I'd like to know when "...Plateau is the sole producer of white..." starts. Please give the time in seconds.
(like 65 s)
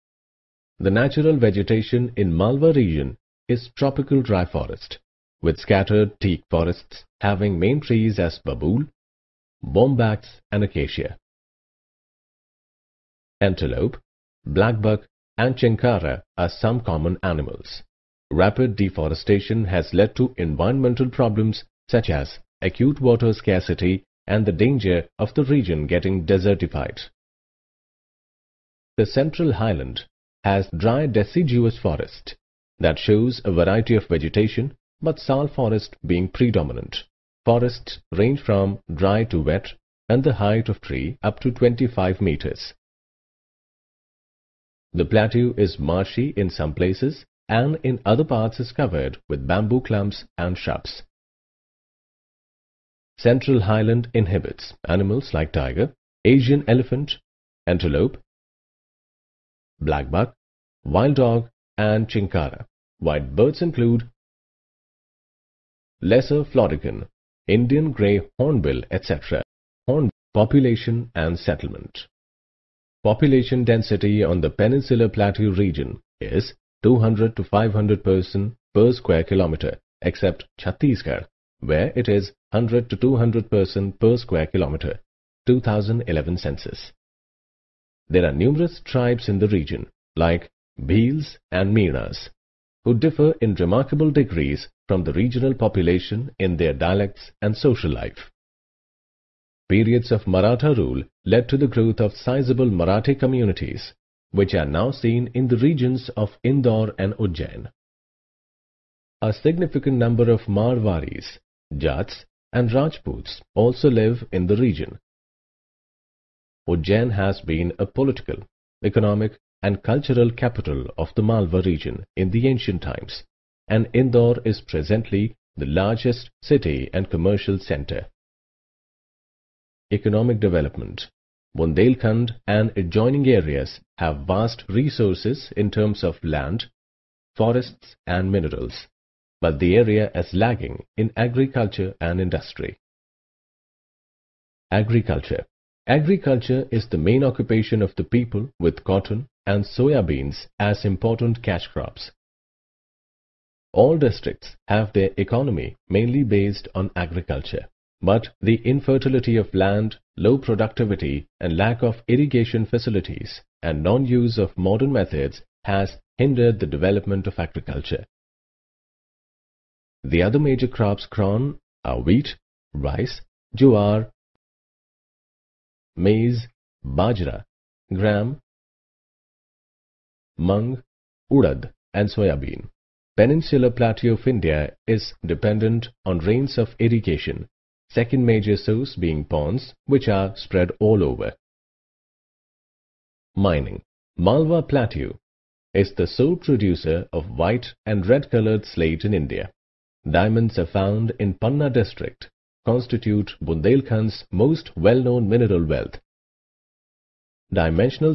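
194 s.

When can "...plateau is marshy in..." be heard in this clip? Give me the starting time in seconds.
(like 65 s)
45 s.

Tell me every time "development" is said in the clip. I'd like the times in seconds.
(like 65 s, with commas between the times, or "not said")
130 s, 166 s.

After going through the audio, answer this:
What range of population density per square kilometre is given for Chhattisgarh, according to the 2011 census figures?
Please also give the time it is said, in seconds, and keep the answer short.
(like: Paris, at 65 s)
100 to 200, at 82 s.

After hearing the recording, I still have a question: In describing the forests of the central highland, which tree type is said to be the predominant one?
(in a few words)
Sal.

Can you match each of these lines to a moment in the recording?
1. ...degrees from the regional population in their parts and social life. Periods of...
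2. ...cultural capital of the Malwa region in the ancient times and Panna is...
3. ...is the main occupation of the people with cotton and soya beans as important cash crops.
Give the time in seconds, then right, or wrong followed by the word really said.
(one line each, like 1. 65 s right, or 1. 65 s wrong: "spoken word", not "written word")
1. 94 s wrong: "dialects", not "parts"
2. 119 s wrong: "Indore", not "Panna"
3. 146 s right.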